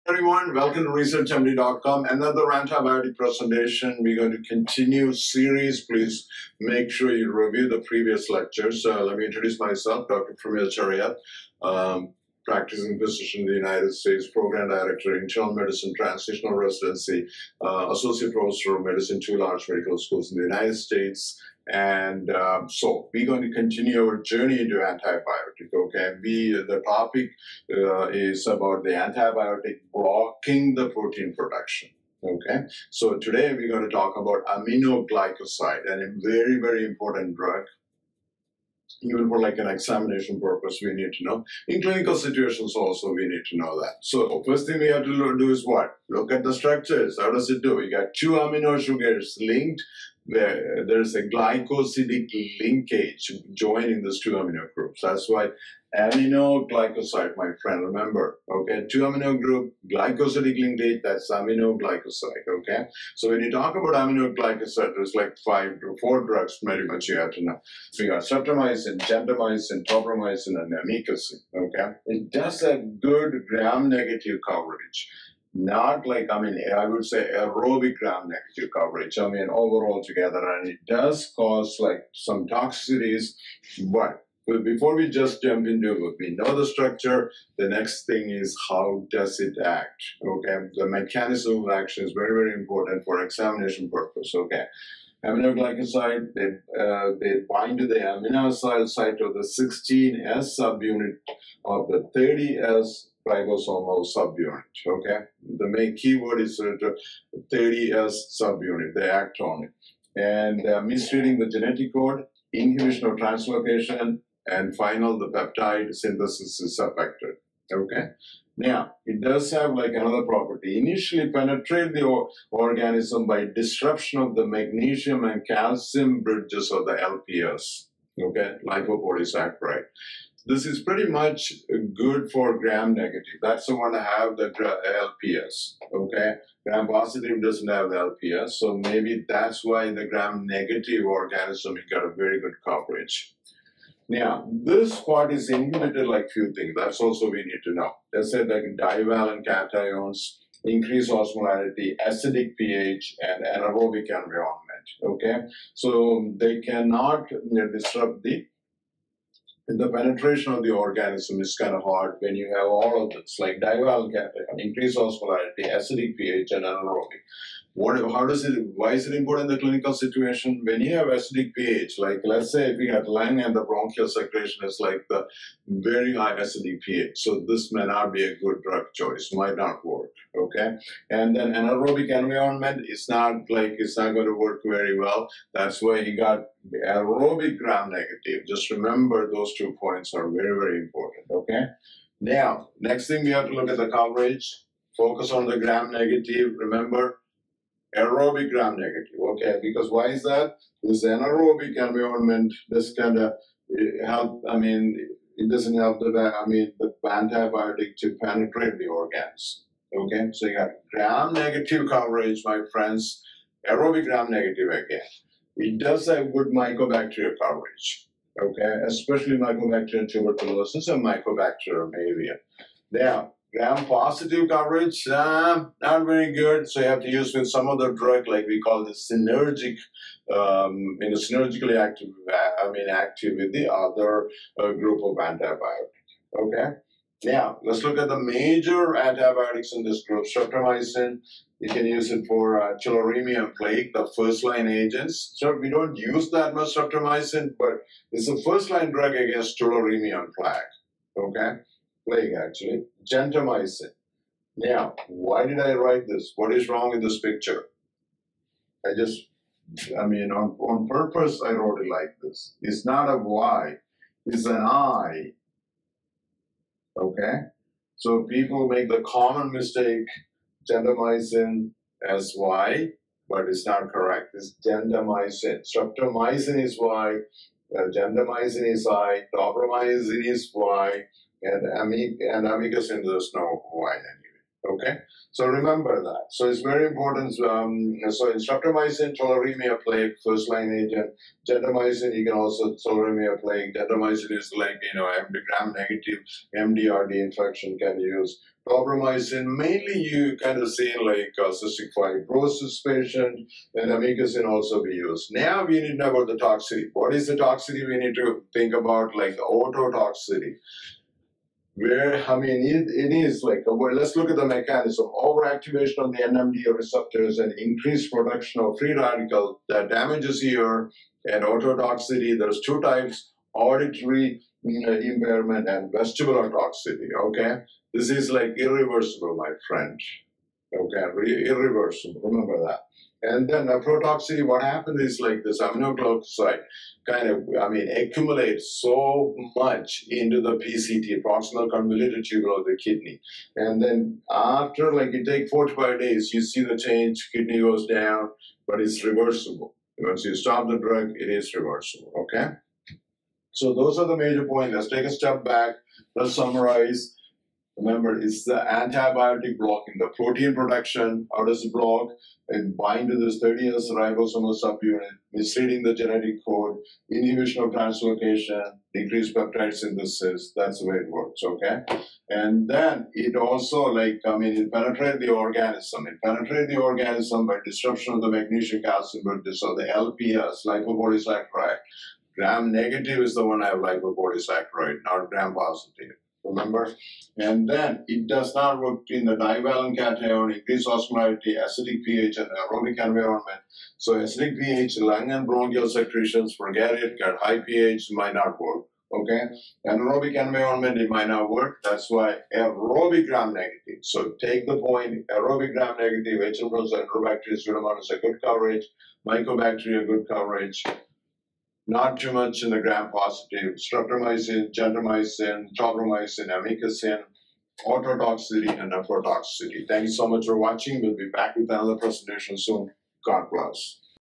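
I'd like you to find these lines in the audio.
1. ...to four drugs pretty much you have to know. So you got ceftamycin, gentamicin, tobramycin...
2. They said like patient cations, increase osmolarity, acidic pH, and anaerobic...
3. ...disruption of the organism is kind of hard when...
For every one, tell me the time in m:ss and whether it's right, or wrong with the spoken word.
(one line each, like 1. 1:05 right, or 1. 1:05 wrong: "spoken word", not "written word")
1. 1:05 right
2. 2:28 wrong: "divalent", not "patient"
3. 2:39 wrong: "penetration", not "disruption".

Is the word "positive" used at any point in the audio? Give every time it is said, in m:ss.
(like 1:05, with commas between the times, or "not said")
2:16, 3:43, 6:25, 6:52.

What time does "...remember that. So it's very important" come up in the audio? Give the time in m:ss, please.
4:45.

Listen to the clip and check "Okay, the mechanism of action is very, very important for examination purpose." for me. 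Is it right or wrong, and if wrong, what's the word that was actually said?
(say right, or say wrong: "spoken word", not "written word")
right.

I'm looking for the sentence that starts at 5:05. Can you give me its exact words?
Now we need to know about the toxicity.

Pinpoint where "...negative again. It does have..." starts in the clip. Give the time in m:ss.
3:34.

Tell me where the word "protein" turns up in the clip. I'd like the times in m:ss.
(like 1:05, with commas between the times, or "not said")
0:30, 6:00.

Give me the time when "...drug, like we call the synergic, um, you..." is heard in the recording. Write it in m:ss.
3:47.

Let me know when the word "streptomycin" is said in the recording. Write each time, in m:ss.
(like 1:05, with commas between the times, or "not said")
4:00, 4:06, 4:35, 4:48, 6:53.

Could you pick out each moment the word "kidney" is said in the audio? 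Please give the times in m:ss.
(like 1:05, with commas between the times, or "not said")
5:42, 5:47.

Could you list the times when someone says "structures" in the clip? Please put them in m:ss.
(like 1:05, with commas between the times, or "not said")
0:46, 1:26.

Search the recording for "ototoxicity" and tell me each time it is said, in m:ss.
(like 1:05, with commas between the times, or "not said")
5:09, 5:21, 6:57.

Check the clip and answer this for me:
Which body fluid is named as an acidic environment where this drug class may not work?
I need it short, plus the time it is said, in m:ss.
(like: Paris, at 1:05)
bronchial secretion, at 2:53.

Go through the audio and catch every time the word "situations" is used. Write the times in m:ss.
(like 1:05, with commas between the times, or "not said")
0:42, 2:49.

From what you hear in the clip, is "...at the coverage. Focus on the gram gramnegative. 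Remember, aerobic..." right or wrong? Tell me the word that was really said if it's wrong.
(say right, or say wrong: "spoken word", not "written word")
wrong: "negative", not "gramnegative".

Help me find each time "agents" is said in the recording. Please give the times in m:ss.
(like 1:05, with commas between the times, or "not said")
4:04, 4:50.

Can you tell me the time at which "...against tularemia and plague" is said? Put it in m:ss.
4:09.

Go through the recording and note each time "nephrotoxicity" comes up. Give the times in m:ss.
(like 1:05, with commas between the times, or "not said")
5:33, 6:58.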